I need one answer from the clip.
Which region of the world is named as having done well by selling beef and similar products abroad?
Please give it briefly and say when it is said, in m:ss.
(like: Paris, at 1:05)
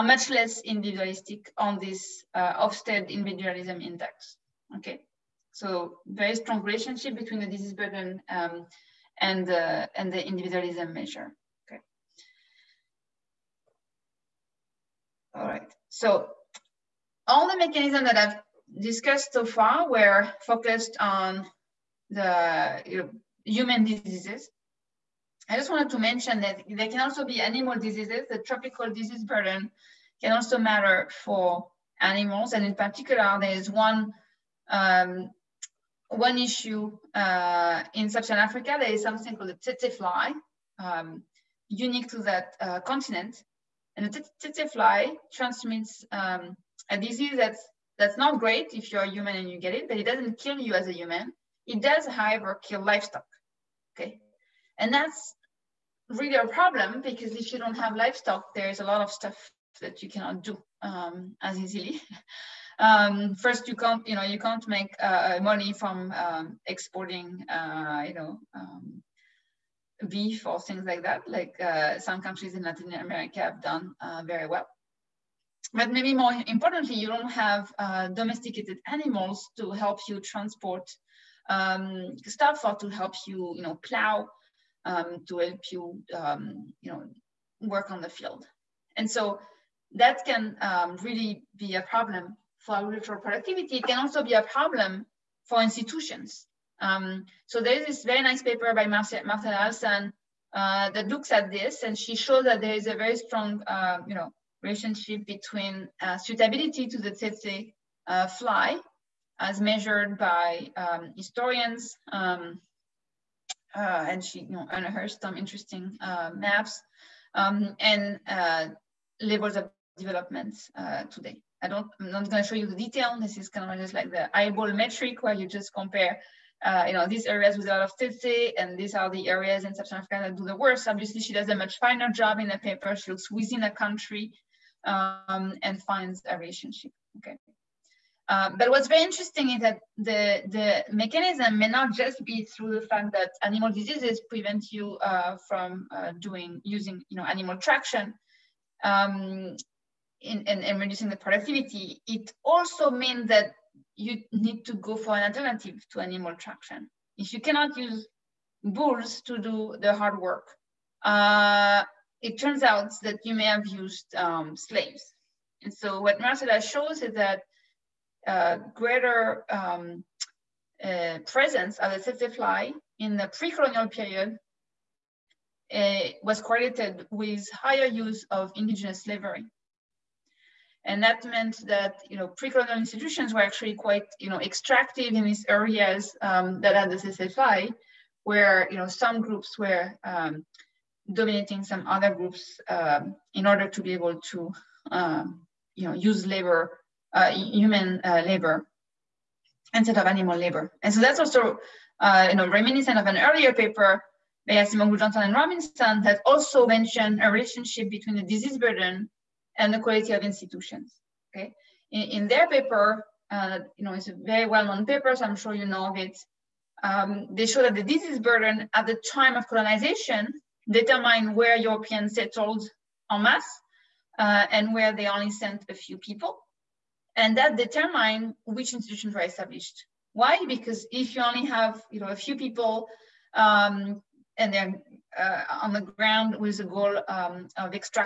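Latin America, at 1:12.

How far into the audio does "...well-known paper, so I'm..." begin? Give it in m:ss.
3:34.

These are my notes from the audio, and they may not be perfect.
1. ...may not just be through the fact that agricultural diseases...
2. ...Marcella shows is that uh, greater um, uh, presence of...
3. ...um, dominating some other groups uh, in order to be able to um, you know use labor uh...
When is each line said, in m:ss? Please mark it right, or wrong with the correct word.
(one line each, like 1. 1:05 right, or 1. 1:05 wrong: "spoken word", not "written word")
1. 2:21 wrong: "animal", not "agricultural"
2. 2:46 right
3. 3:10 right.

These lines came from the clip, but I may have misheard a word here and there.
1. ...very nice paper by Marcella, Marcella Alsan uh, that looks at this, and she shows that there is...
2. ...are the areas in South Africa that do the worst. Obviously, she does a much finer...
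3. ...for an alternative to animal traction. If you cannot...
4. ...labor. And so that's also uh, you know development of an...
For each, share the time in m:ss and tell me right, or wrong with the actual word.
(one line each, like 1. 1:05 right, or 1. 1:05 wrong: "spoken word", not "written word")
1. 1:38 right
2. 2:08 right
3. 2:34 right
4. 3:20 wrong: "reminiscent", not "development".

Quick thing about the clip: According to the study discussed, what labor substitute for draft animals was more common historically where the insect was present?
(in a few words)
indigenous slavery.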